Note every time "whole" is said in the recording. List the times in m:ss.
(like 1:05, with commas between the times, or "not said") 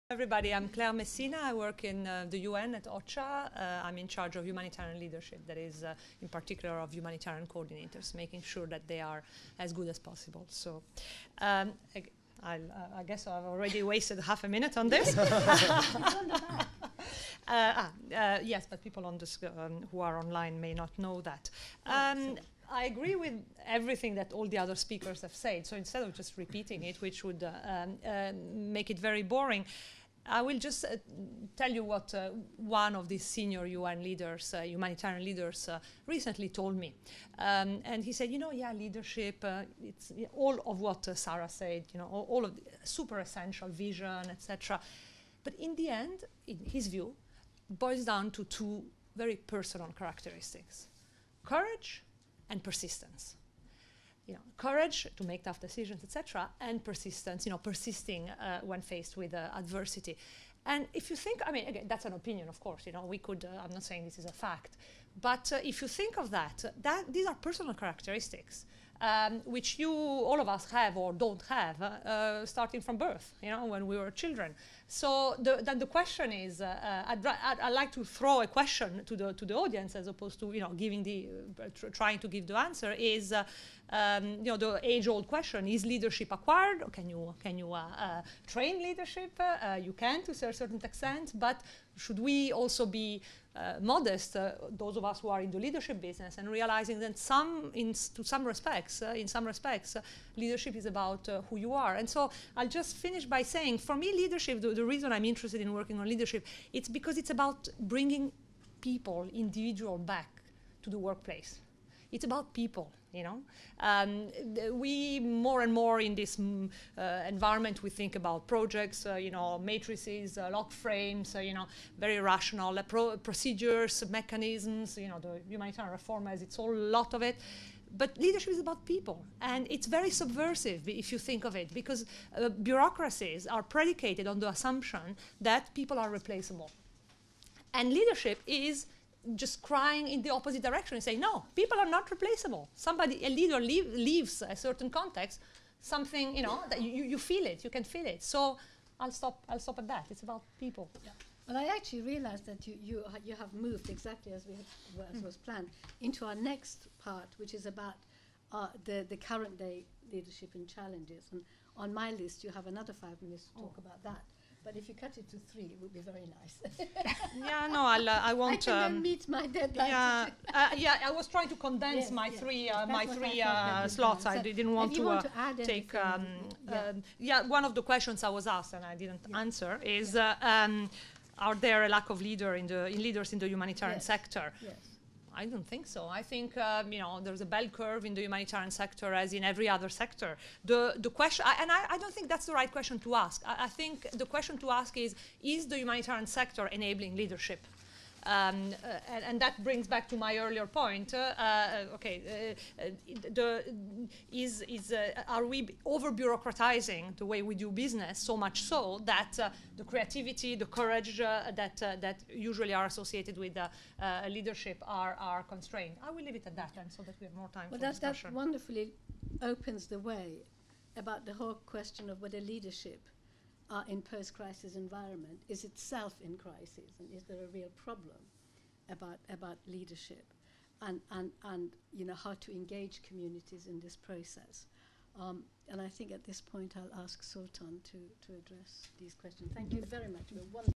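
2:06, 3:41.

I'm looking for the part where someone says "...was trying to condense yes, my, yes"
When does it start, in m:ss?
2:51.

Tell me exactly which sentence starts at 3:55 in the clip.
Um, and I think at this point I'll ask Sultan to, to address these questions.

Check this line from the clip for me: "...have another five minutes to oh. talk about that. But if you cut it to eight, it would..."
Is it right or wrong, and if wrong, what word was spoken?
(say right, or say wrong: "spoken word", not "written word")
wrong: "three", not "eight".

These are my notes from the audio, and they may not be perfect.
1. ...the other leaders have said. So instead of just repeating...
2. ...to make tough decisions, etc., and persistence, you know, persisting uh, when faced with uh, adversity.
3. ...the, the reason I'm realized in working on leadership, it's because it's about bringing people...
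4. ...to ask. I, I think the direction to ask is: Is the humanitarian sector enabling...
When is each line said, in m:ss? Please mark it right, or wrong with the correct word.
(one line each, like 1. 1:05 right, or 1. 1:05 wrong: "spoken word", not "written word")
1. 0:24 wrong: "speakers", not "leaders"
2. 0:55 right
3. 1:44 wrong: "interested", not "realized"
4. 3:12 wrong: "question", not "direction".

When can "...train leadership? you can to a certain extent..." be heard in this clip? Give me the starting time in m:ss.
1:28.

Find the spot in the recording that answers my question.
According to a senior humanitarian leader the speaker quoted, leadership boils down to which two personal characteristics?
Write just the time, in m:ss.
0:51.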